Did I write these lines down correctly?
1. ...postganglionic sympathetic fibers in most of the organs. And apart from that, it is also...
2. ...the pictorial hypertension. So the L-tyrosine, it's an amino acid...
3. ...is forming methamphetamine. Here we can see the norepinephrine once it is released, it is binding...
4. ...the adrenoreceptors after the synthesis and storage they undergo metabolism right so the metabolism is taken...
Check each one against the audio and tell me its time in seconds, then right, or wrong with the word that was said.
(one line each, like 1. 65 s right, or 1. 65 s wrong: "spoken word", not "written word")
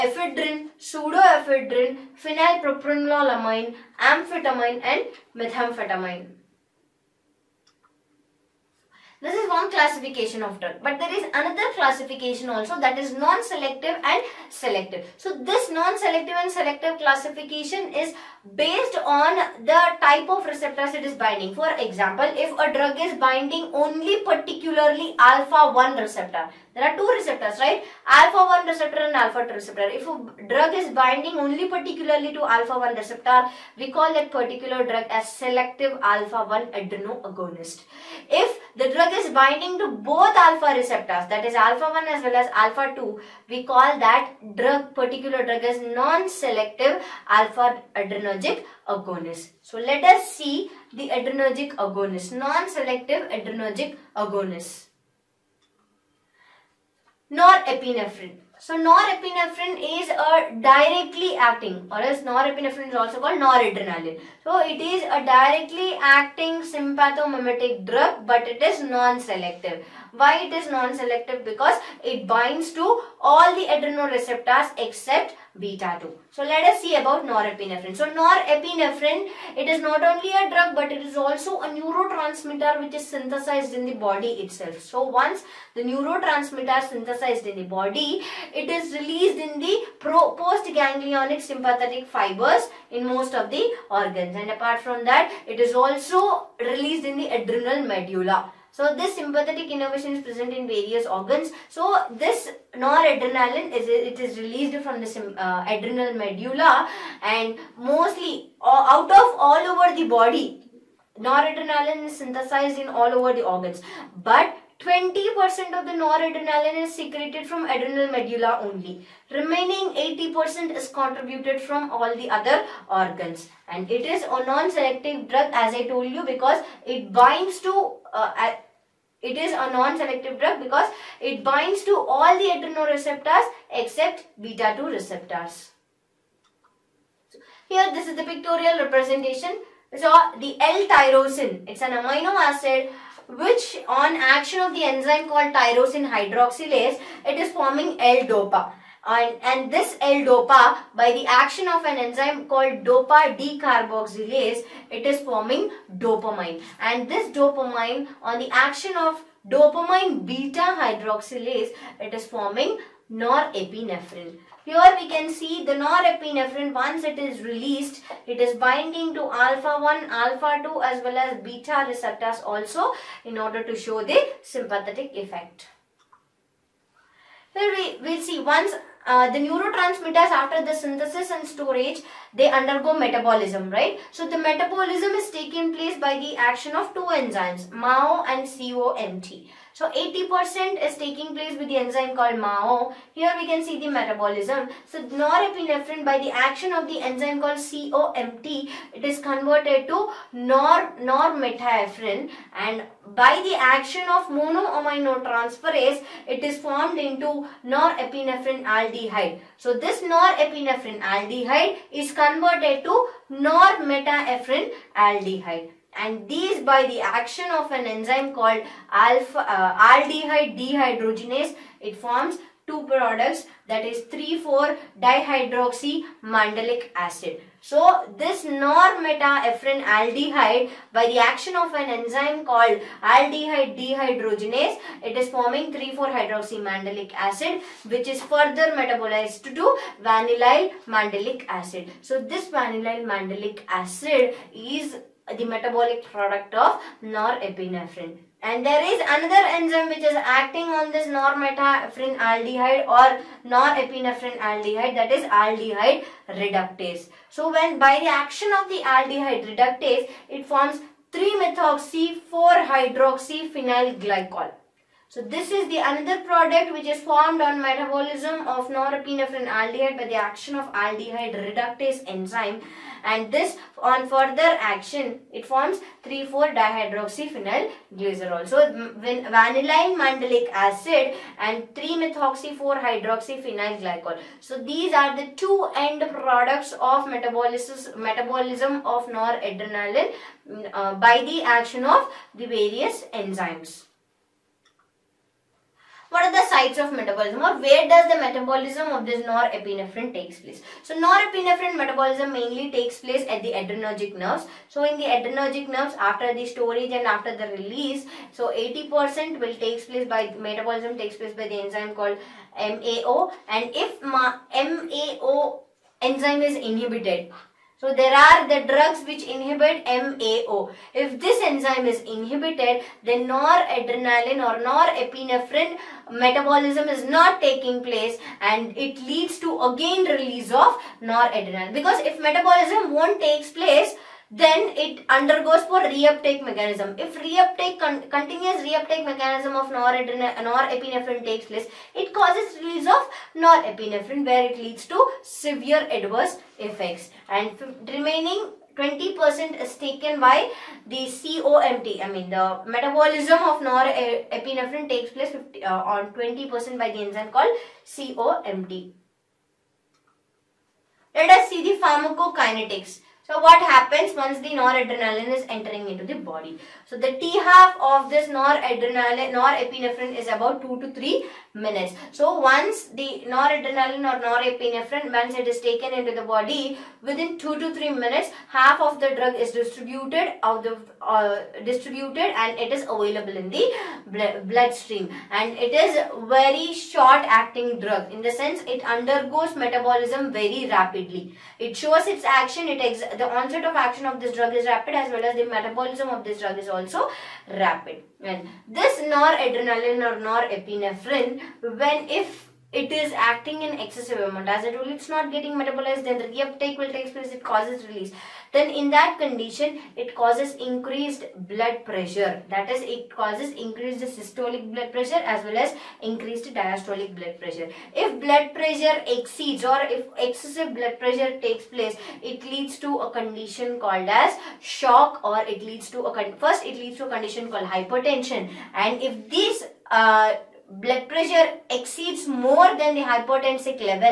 1. 90 s right
2. 138 s wrong: "representation", not "hypertension"
3. 162 s wrong: "norepinephrine", not "methamphetamine"
4. 179 s wrong: "neurotransmitters", not "adrenoreceptors".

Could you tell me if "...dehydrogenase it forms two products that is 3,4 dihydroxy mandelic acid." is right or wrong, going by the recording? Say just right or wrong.
right.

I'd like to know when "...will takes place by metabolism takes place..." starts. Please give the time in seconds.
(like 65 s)
309 s.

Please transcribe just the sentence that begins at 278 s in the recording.
So when vanillin mandelic acid and 3 methoxy 4 hydroxyphenyl glycol.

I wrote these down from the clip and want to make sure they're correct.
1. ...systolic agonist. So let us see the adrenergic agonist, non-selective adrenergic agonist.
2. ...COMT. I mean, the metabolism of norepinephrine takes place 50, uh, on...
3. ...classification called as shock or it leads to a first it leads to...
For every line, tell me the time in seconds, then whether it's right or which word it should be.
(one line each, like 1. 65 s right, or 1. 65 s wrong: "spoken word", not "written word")
1. 47 s wrong: "adrenergic", not "systolic"
2. 351 s right
3. 423 s wrong: "condition", not "classification".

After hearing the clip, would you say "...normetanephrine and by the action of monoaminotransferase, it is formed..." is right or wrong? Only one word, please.
right.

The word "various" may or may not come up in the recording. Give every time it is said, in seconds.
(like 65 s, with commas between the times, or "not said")
100 s, 292 s.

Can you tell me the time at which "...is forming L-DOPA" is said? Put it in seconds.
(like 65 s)
147 s.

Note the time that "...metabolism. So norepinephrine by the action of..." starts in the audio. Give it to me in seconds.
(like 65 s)
193 s.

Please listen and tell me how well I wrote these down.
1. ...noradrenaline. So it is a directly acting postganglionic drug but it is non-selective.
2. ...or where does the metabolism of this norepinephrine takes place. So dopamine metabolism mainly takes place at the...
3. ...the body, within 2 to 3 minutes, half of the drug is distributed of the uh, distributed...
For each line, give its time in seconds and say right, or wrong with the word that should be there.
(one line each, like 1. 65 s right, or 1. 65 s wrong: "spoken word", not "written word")
1. 63 s wrong: "sympathomimetic", not "postganglionic"
2. 297 s wrong: "norepinephrine", not "dopamine"
3. 376 s right.